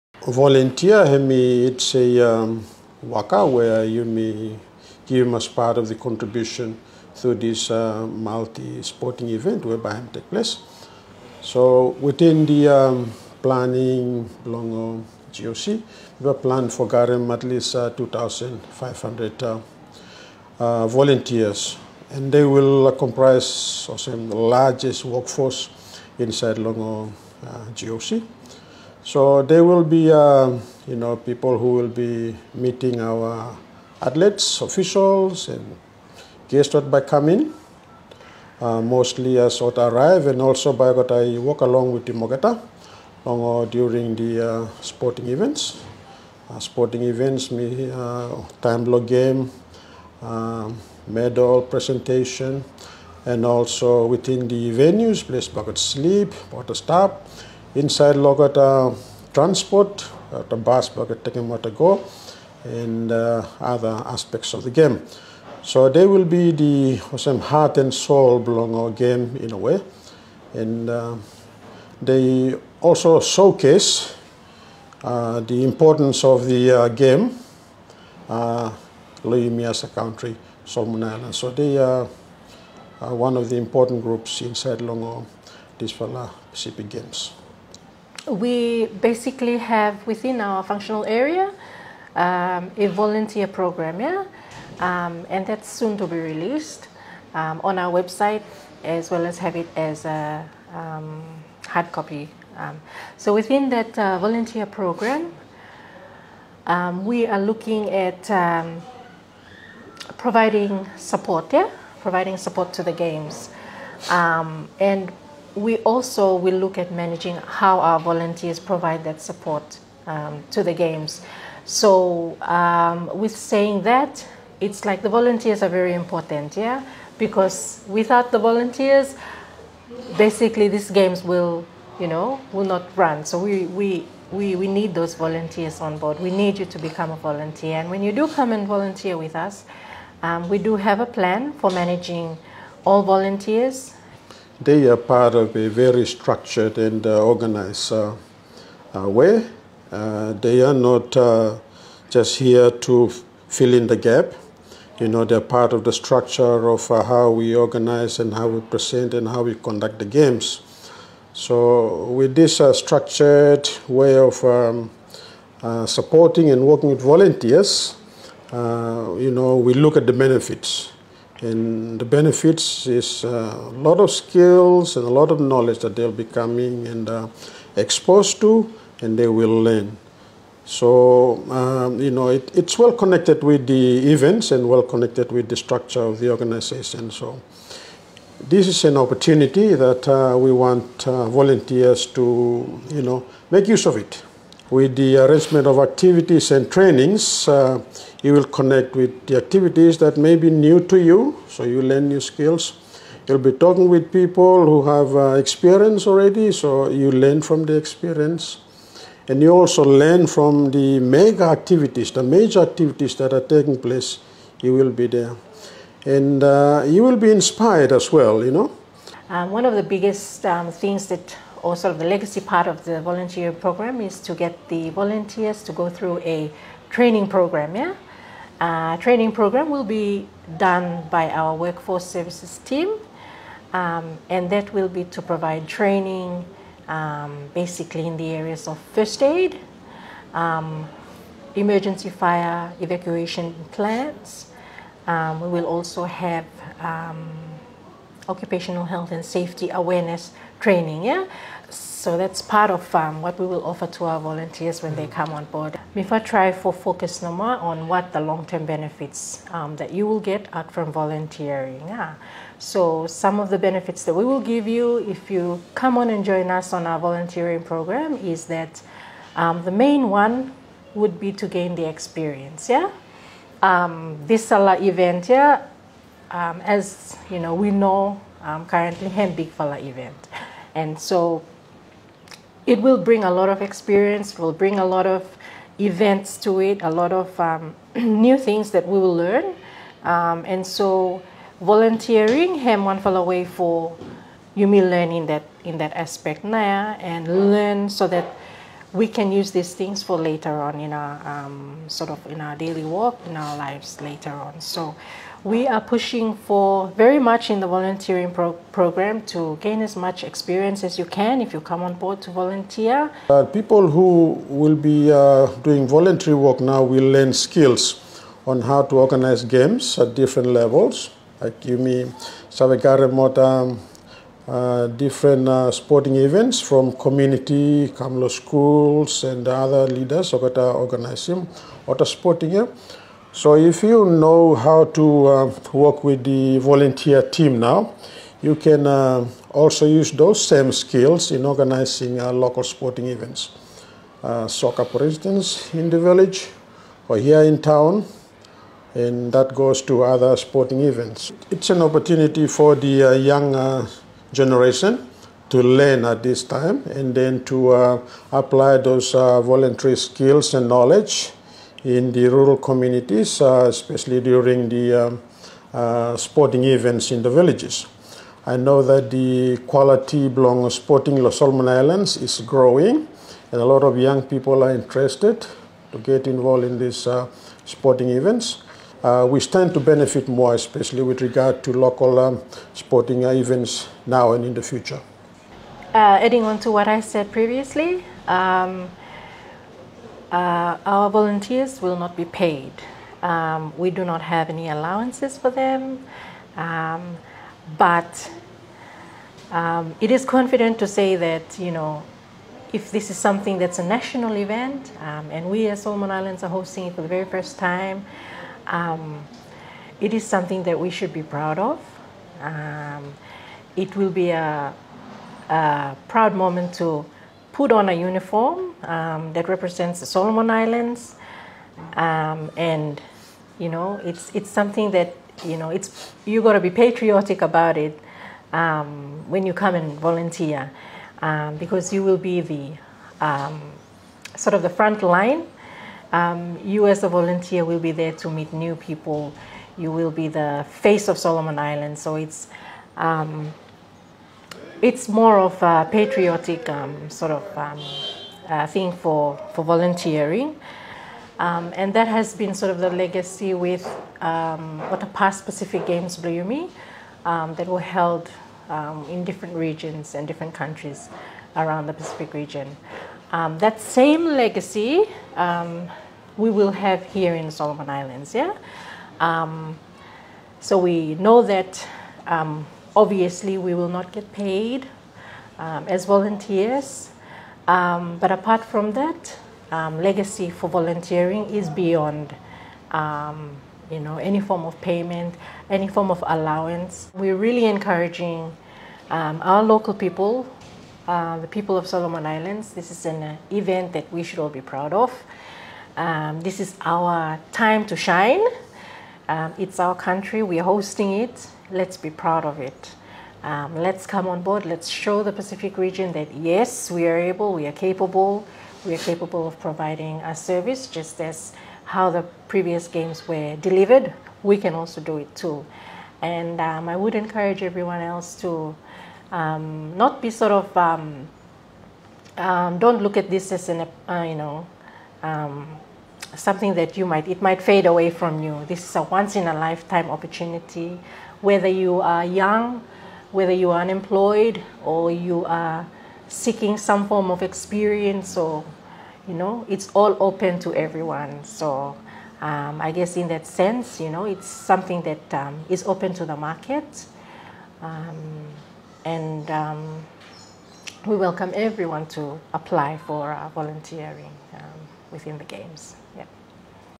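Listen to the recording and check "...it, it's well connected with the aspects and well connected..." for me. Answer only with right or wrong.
wrong.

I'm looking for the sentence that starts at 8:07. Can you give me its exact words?
We're really encouraging um, our local people, uh, the people of Solomon Islands.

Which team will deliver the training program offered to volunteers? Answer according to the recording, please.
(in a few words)
workforce services team.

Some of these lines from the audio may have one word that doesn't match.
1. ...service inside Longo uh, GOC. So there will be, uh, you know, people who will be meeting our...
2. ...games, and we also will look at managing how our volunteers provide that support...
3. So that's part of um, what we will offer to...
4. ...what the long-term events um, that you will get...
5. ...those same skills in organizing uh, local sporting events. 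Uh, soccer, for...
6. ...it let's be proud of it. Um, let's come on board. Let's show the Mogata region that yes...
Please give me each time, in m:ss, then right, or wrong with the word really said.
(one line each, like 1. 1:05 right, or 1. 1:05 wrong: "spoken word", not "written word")
1. 0:25 wrong: "workforce", not "service"
2. 1:52 right
3. 4:11 right
4. 4:17 wrong: "benefits", not "events"
5. 5:40 right
6. 8:21 wrong: "Pacific", not "Mogata".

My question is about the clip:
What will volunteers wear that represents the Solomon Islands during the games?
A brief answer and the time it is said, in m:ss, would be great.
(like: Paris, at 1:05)
a uniform, at 6:57.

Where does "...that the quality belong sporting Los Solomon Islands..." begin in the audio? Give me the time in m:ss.
6:08.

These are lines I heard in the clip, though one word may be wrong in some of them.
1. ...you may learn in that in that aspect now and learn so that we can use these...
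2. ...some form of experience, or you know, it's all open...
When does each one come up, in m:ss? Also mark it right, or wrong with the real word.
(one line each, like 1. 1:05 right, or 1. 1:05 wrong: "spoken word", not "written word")
1. 4:54 right
2. 8:56 right.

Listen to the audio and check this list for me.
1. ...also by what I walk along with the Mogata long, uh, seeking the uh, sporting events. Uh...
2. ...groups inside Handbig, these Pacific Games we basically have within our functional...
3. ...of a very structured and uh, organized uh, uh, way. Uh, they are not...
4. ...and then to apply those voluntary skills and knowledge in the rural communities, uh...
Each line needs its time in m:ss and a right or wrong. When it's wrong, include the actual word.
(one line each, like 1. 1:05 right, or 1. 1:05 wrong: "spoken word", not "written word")
1. 0:40 wrong: "during", not "seeking"
2. 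1:24 wrong: "Longo", not "Handbig"
3. 2:25 right
4. 5:56 right.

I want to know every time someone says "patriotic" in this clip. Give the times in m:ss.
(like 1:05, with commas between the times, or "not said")
7:06, 7:25.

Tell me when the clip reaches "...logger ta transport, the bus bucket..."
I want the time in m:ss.
0:58.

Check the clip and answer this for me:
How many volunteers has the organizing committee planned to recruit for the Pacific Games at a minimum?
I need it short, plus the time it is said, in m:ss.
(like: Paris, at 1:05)
2,500, at 0:17.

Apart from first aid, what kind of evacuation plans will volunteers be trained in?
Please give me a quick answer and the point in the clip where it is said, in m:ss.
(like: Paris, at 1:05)
emergency fire evacuation, at 4:01.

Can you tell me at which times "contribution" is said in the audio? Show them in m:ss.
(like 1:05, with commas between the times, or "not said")
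0:05.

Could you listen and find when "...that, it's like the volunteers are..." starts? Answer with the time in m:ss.
2:03.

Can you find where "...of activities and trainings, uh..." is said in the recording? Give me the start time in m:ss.
3:15.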